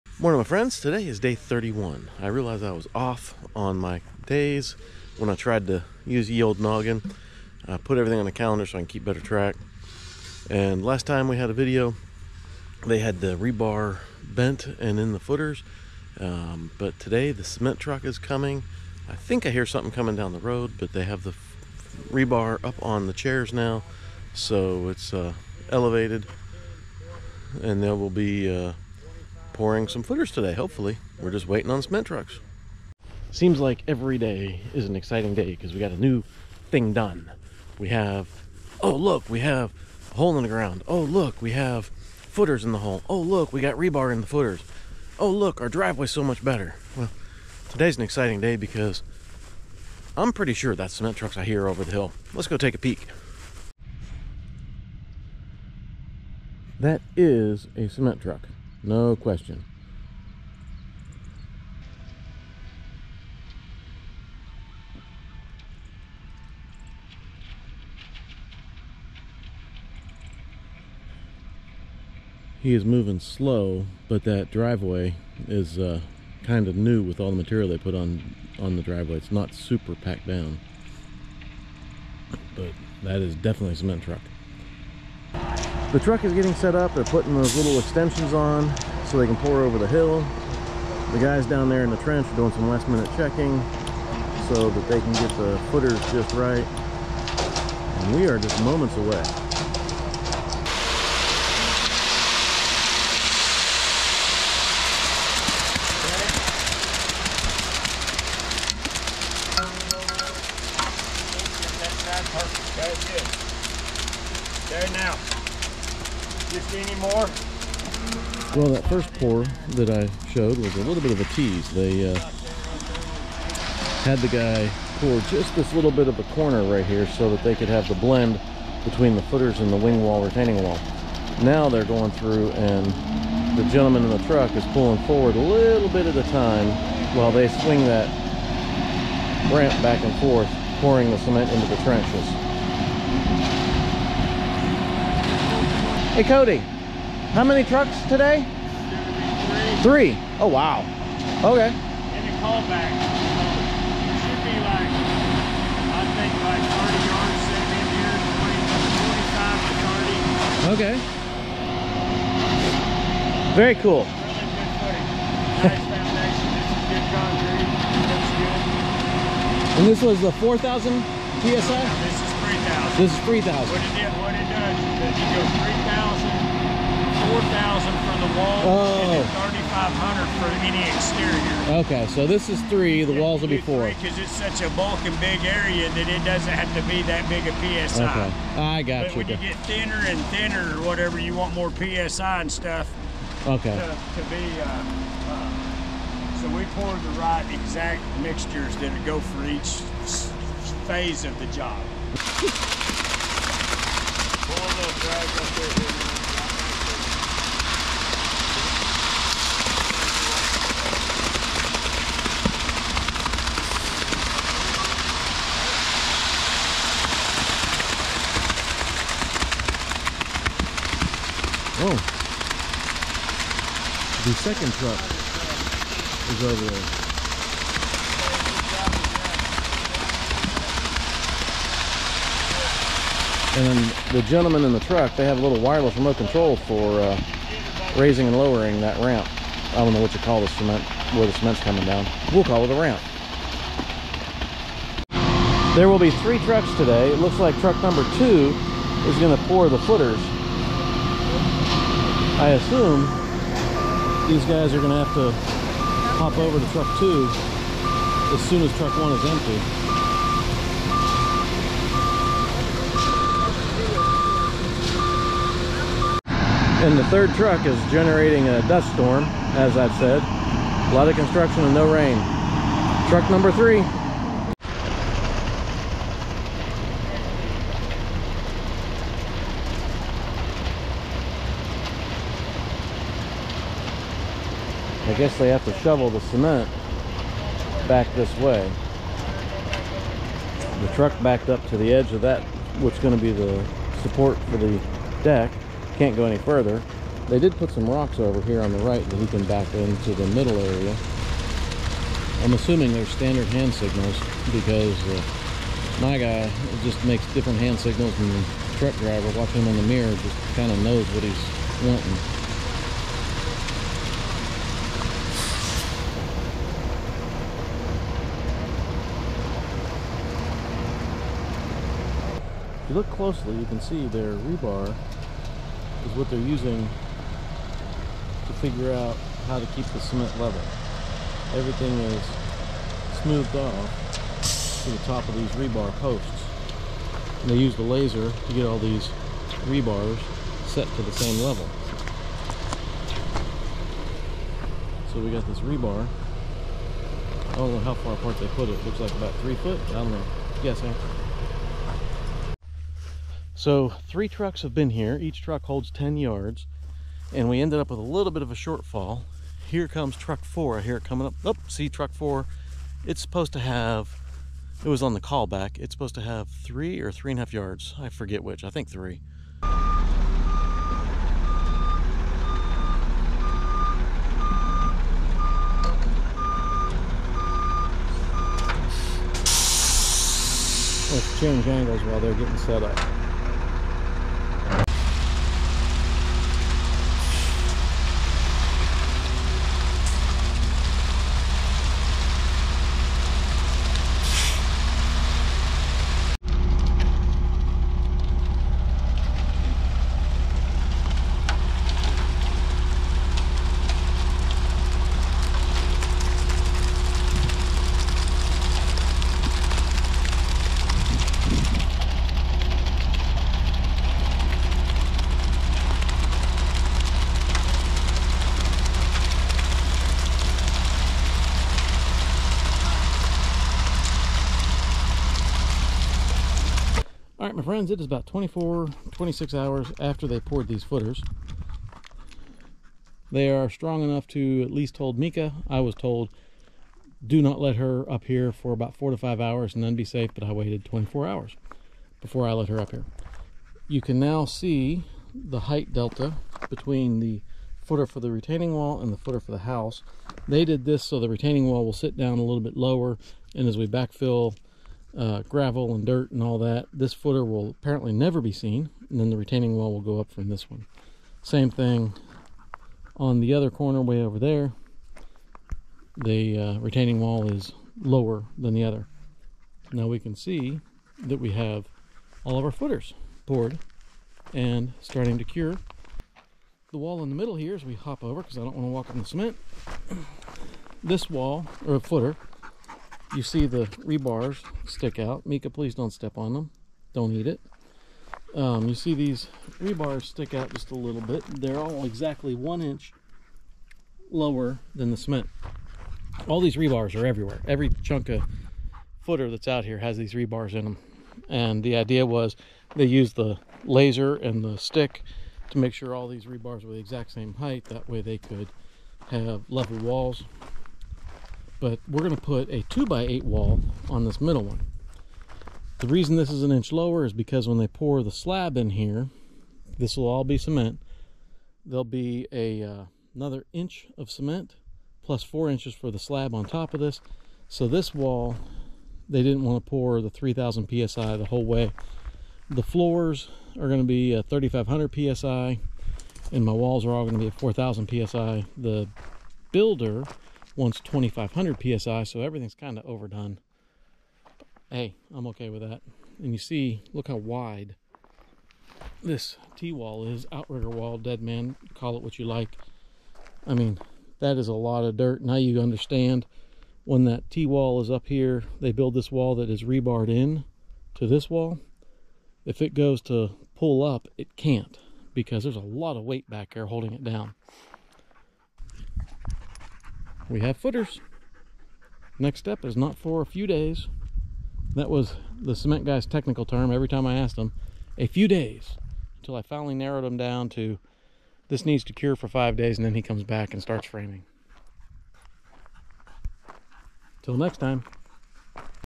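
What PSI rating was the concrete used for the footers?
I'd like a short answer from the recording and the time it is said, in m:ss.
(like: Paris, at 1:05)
3,000, at 2:52.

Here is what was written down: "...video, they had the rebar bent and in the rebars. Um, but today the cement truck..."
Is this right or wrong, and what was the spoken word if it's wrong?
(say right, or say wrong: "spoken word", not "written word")
wrong: "footers", not "rebars".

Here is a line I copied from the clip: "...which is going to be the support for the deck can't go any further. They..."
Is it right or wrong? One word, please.
right.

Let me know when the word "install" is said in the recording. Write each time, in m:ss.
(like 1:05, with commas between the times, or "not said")
not said.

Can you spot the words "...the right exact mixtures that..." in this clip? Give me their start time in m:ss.
3:16.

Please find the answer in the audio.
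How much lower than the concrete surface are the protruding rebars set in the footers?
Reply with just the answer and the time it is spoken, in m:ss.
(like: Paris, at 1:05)
1 inch, at 8:12.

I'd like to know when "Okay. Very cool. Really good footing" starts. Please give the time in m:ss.
2:40.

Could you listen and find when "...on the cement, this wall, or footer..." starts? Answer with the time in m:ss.
7:59.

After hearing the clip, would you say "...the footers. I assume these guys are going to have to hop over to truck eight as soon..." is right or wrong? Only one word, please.
wrong.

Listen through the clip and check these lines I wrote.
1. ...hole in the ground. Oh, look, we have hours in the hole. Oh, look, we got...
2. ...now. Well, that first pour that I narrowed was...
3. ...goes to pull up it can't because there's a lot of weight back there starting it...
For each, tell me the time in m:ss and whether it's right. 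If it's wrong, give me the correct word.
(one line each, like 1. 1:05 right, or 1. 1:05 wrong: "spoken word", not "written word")
1. 0:40 wrong: "footers", not "hours"
2. 1:54 wrong: "showed", not "narrowed"
3. 9:22 wrong: "holding", not "starting".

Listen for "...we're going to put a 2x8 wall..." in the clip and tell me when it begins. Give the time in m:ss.
8:32.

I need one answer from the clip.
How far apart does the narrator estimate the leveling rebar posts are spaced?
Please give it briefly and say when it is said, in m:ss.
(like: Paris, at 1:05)
3 feet, at 5:49.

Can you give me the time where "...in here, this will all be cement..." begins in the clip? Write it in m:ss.
8:38.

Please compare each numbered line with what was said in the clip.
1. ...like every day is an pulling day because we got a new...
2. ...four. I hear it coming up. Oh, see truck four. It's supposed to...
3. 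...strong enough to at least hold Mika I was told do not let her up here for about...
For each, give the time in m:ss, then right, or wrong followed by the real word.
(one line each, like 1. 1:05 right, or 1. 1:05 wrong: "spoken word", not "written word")
1. 0:33 wrong: "exciting", not "pulling"
2. 6:00 right
3. 7:13 right.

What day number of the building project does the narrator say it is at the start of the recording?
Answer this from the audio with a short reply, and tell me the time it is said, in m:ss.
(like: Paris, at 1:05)
31, at 0:01.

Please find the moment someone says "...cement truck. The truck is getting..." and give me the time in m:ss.
1:23.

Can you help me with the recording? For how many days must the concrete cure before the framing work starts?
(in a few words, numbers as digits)
5 days.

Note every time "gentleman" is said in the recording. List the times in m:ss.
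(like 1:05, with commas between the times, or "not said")
2:13, 3:54.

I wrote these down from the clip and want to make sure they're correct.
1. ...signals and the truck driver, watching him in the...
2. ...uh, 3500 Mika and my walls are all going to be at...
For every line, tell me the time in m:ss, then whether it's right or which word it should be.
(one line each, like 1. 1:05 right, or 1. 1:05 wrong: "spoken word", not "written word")
1. 5:07 right
2. 8:54 wrong: "PSI", not "Mika".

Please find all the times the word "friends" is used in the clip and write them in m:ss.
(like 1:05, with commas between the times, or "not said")
0:00, 7:07.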